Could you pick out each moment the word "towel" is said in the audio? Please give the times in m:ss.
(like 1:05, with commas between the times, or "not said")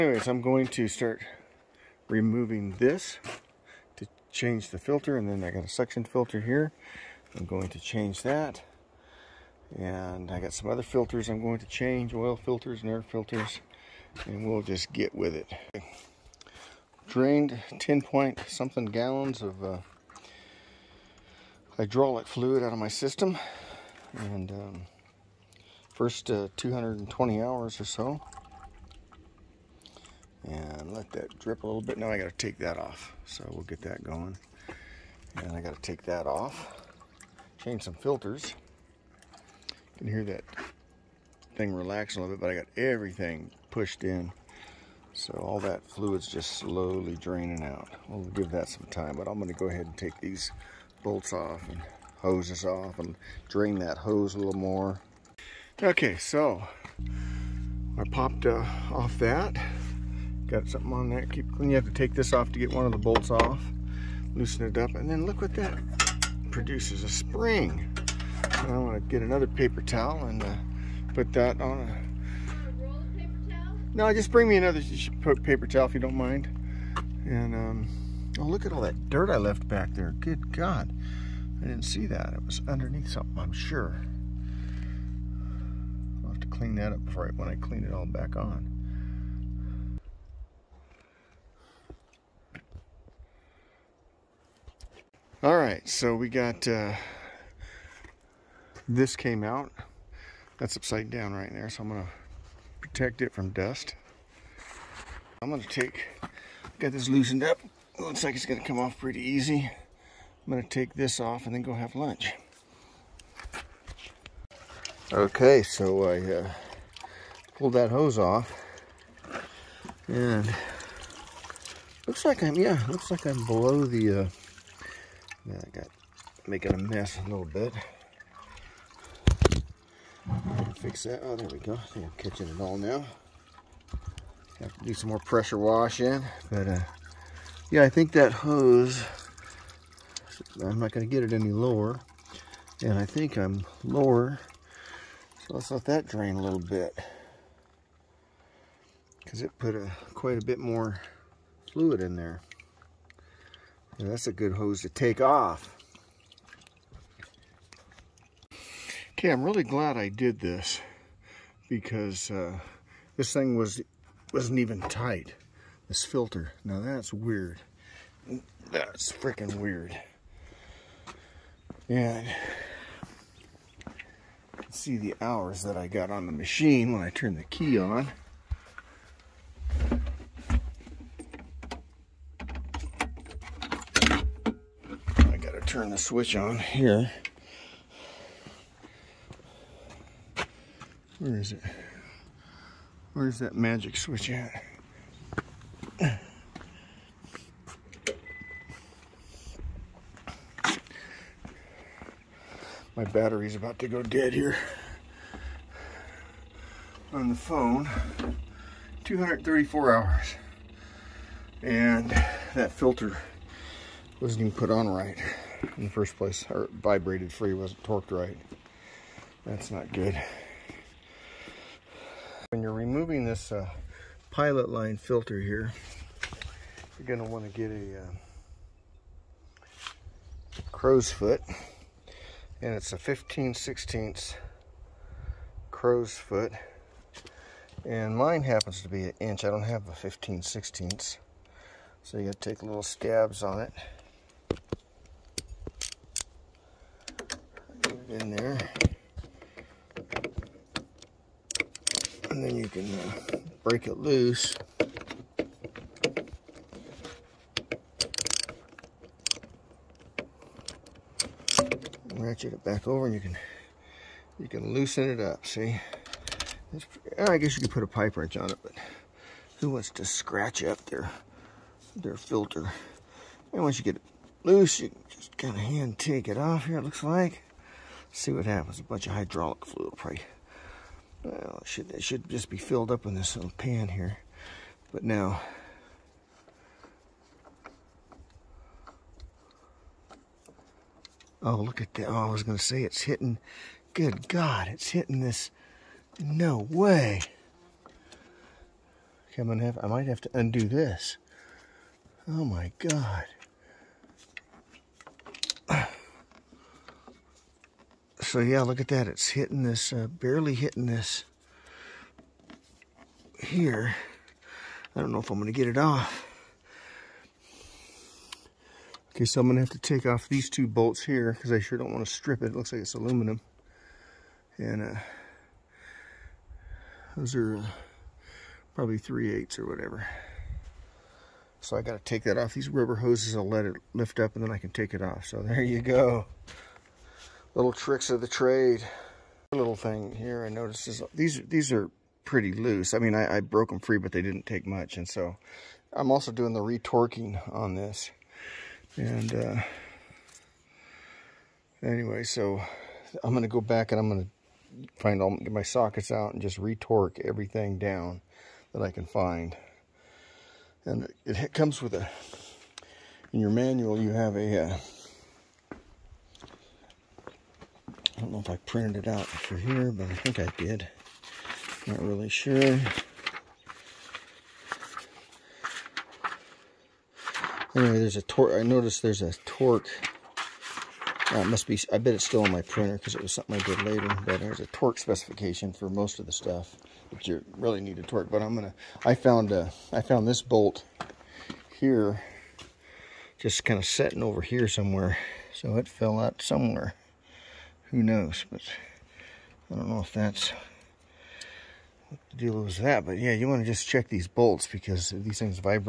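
1:09, 1:15.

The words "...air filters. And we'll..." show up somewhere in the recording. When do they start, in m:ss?
0:12.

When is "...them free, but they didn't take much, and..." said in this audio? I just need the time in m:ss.
5:43.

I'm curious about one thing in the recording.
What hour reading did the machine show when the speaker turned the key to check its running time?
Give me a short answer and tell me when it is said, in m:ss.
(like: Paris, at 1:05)
234 hours, at 3:29.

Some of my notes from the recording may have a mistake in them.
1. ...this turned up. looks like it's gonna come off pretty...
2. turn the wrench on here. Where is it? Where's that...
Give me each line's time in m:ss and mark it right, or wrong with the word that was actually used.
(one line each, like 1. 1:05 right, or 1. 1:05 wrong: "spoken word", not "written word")
1. 1:46 wrong: "loosened", not "turned"
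2. 3:05 wrong: "switch", not "wrench".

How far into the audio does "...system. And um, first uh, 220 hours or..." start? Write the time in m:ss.
0:22.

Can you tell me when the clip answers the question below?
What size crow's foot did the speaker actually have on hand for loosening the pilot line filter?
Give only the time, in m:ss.
3:59.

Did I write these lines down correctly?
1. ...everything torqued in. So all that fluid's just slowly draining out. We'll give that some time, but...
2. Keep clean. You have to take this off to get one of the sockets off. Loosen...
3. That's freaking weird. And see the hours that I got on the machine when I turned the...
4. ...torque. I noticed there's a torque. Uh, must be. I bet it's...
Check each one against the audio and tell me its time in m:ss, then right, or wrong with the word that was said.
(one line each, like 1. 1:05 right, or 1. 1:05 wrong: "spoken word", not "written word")
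1. 0:42 wrong: "pushed", not "torqued"
2. 1:01 wrong: "bolts", not "sockets"
3. 2:48 right
4. 6:18 right.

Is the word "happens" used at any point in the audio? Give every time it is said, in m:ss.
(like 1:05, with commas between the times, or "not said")
3:58, 4:38.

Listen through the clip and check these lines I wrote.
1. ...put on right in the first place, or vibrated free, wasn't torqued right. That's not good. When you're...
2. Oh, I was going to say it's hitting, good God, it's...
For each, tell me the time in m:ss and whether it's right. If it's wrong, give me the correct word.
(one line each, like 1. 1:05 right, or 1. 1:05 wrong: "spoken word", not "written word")
1. 3:34 right
2. 4:52 right.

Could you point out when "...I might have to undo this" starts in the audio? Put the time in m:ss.
4:59.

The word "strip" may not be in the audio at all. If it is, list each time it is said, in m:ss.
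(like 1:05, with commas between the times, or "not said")
5:22.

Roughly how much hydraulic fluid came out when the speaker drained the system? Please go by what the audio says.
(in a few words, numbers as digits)
10 point something gallons.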